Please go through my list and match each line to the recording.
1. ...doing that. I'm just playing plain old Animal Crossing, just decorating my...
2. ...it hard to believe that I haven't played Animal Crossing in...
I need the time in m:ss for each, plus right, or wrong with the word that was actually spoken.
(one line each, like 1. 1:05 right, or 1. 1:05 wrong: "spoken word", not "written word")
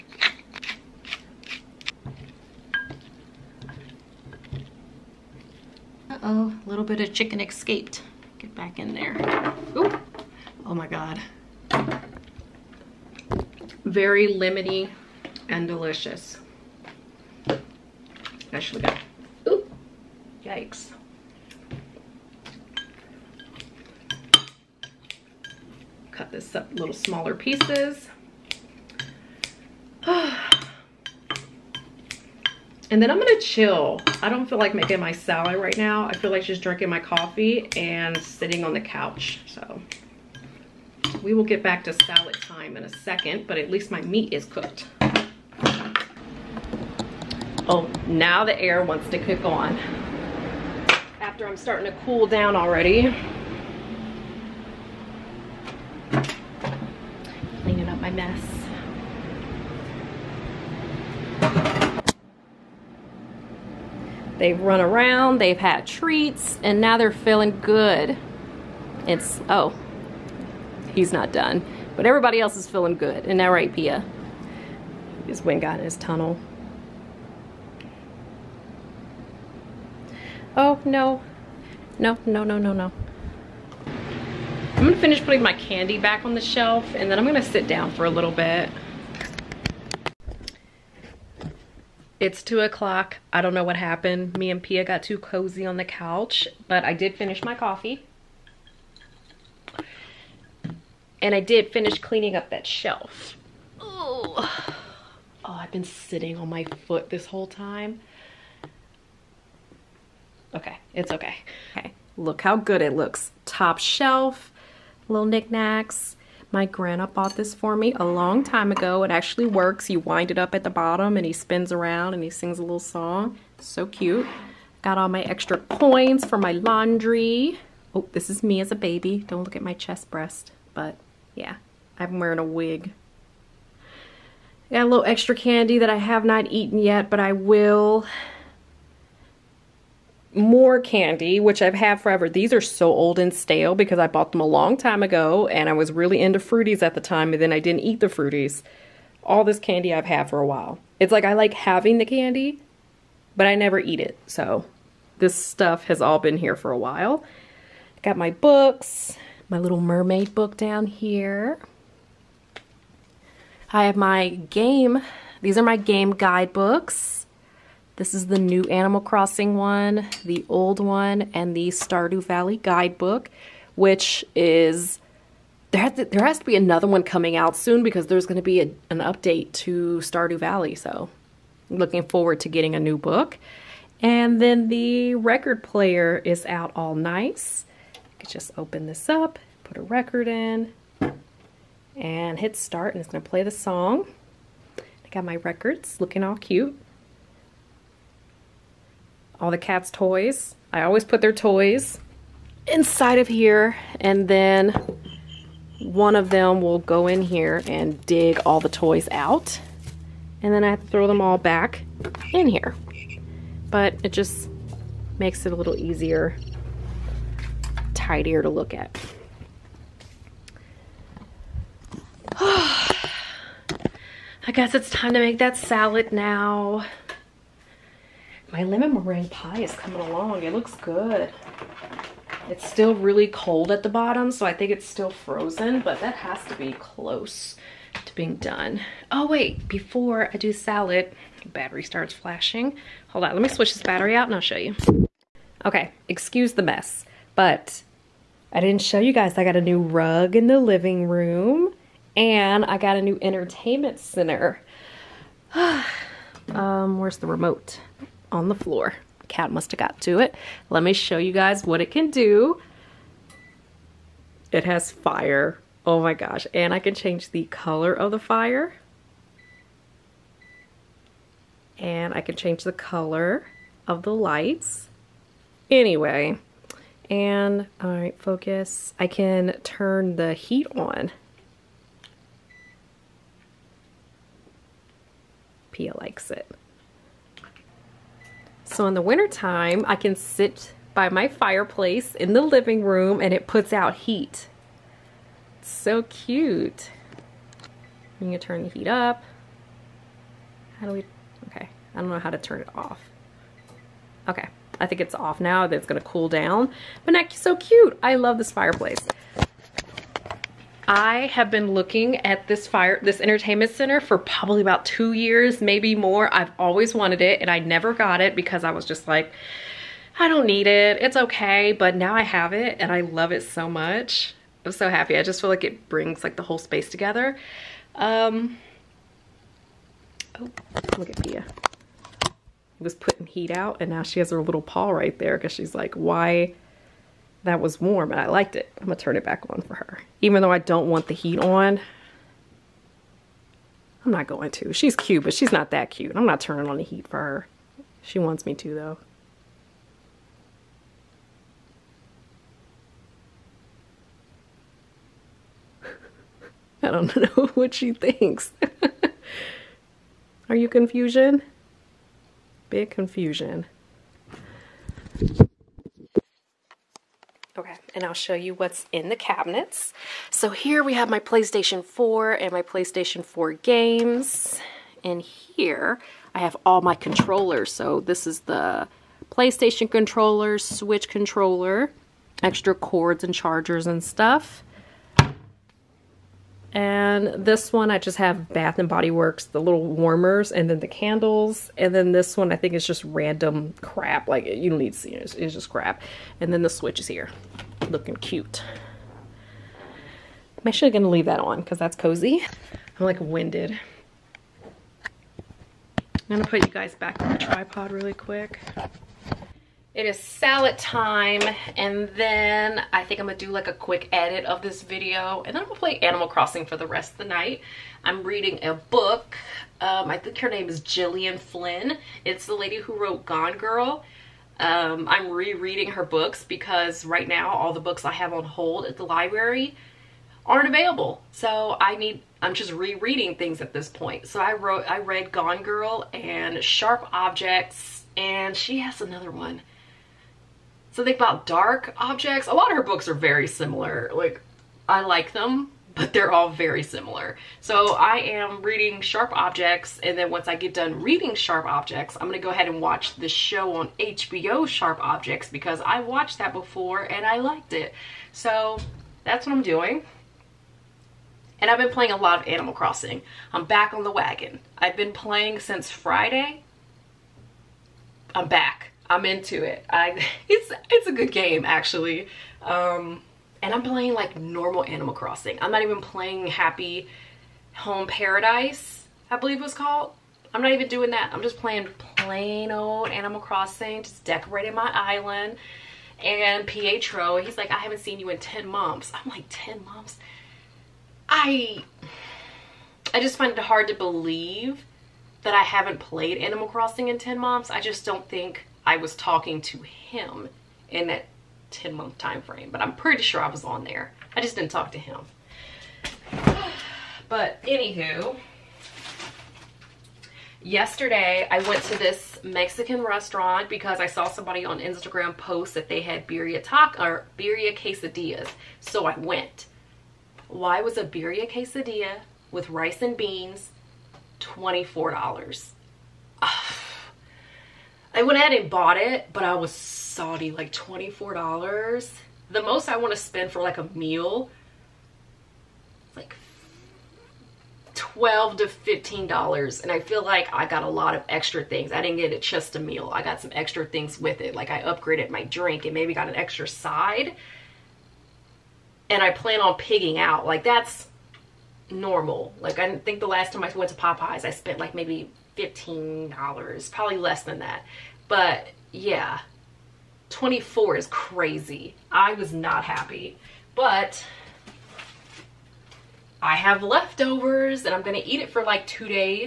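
1. 8:00 right
2. 8:13 right.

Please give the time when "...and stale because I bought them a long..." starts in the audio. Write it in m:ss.
2:23.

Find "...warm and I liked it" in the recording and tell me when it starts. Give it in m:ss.
5:37.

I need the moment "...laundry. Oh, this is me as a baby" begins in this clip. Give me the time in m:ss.
2:06.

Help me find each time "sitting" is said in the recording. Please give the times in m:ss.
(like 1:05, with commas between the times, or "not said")
0:38, 1:45.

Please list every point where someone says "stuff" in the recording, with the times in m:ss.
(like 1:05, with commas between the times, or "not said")
2:35, 6:24.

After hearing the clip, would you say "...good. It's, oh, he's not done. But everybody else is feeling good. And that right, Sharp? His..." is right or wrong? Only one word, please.
wrong.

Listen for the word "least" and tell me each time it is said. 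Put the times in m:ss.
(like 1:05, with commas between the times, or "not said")
0:43.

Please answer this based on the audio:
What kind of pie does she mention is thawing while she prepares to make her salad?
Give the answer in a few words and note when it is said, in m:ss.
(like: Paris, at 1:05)
Lemon meringue, at 3:48.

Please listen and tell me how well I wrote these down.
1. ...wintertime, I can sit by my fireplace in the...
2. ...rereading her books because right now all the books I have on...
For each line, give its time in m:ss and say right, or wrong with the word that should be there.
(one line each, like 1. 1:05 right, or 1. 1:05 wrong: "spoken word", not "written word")
1. 4:49 right
2. 7:05 right.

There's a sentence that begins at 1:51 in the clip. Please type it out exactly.
Okay, look how good it looks.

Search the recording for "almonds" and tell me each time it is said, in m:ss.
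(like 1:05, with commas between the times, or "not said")
not said.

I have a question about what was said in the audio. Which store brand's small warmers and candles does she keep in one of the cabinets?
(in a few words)
Bath and Body Works.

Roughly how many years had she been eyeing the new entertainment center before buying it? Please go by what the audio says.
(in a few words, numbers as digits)
2.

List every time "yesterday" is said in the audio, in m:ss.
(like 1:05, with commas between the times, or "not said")
8:30.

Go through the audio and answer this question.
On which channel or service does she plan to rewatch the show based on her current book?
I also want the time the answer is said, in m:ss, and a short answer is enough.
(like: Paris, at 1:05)
HBO, at 7:33.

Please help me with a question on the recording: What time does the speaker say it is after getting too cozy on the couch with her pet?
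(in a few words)
2 o'clock.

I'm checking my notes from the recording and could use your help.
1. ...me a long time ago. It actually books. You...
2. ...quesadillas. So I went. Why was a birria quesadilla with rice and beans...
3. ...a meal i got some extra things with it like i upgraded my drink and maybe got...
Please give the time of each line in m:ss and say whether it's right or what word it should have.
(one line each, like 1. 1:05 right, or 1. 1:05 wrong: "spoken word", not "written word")
1. 1:57 wrong: "works", not "books"
2. 8:37 right
3. 9:02 right.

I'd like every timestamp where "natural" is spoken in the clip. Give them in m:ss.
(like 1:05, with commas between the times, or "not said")
not said.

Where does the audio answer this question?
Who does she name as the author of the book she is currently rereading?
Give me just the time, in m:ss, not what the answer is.
7:00.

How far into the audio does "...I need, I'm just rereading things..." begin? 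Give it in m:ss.
7:11.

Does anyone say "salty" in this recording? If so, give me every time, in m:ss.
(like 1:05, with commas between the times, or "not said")
8:49.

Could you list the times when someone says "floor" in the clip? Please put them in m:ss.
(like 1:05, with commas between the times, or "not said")
4:18.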